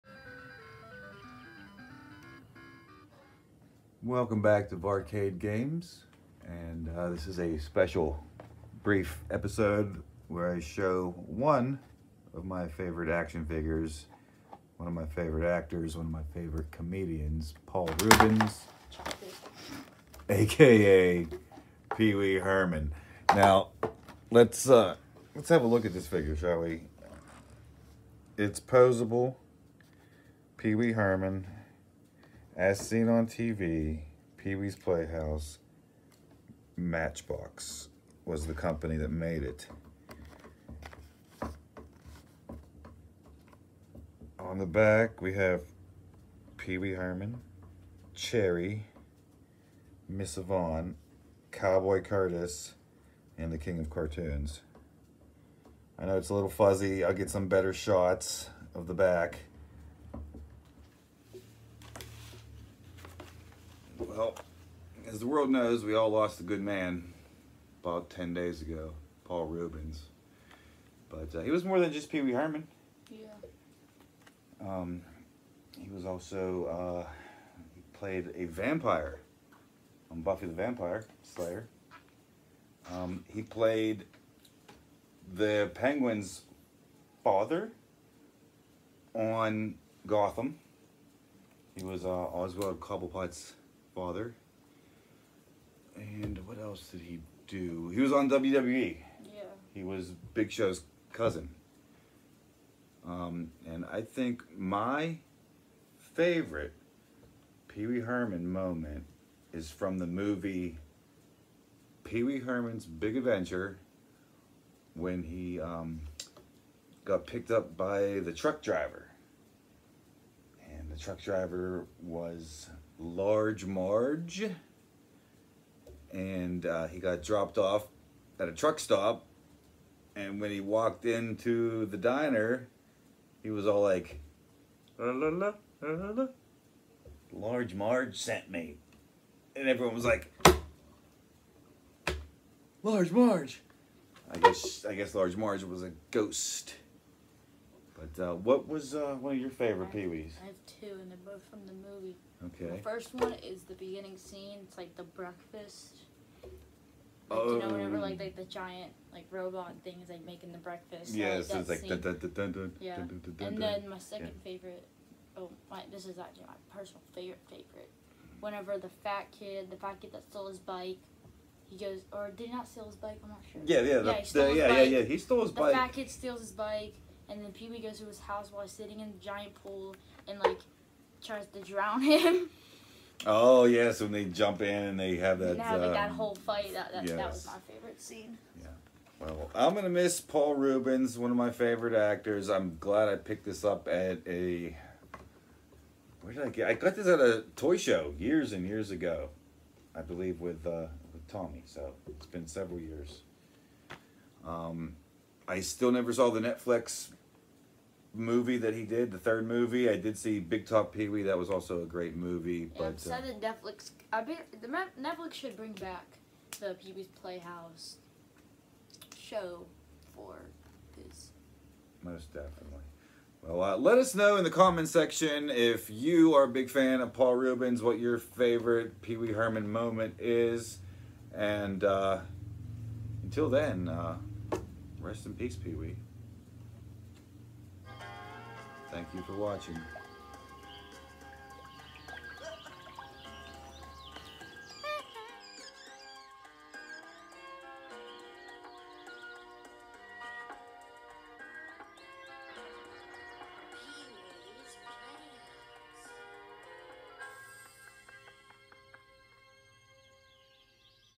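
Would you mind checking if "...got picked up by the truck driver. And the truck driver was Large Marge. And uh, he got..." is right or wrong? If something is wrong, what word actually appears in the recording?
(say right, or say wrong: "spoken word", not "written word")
right.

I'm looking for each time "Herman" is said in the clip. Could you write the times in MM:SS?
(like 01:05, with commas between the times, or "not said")
00:22, 00:30, 00:46, 01:12, 01:47, 01:52, 03:49.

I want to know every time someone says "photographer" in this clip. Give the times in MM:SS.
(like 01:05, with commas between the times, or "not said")
not said.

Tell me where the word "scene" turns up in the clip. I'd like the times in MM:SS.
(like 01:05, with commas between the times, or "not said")
02:34, 03:08.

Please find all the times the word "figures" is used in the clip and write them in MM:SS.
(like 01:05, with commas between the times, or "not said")
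00:13, 00:26.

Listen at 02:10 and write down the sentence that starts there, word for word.
And when he walked into the diner, he was all like, la, la, la, la, la.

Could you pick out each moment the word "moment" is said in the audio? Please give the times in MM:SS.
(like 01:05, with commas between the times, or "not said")
01:48, 03:49.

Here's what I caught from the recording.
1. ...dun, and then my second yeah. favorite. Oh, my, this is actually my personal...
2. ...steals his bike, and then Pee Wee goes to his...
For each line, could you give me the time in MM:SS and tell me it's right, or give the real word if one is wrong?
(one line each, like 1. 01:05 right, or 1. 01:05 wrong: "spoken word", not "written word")
1. 02:43 right
2. 02:56 right.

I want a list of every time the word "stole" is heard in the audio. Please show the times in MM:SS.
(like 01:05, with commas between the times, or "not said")
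02:50, 02:55.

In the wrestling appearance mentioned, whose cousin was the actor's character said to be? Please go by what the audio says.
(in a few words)
Big Show.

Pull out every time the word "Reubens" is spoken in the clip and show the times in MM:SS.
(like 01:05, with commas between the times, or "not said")
00:18, 01:09, 03:10, 03:47.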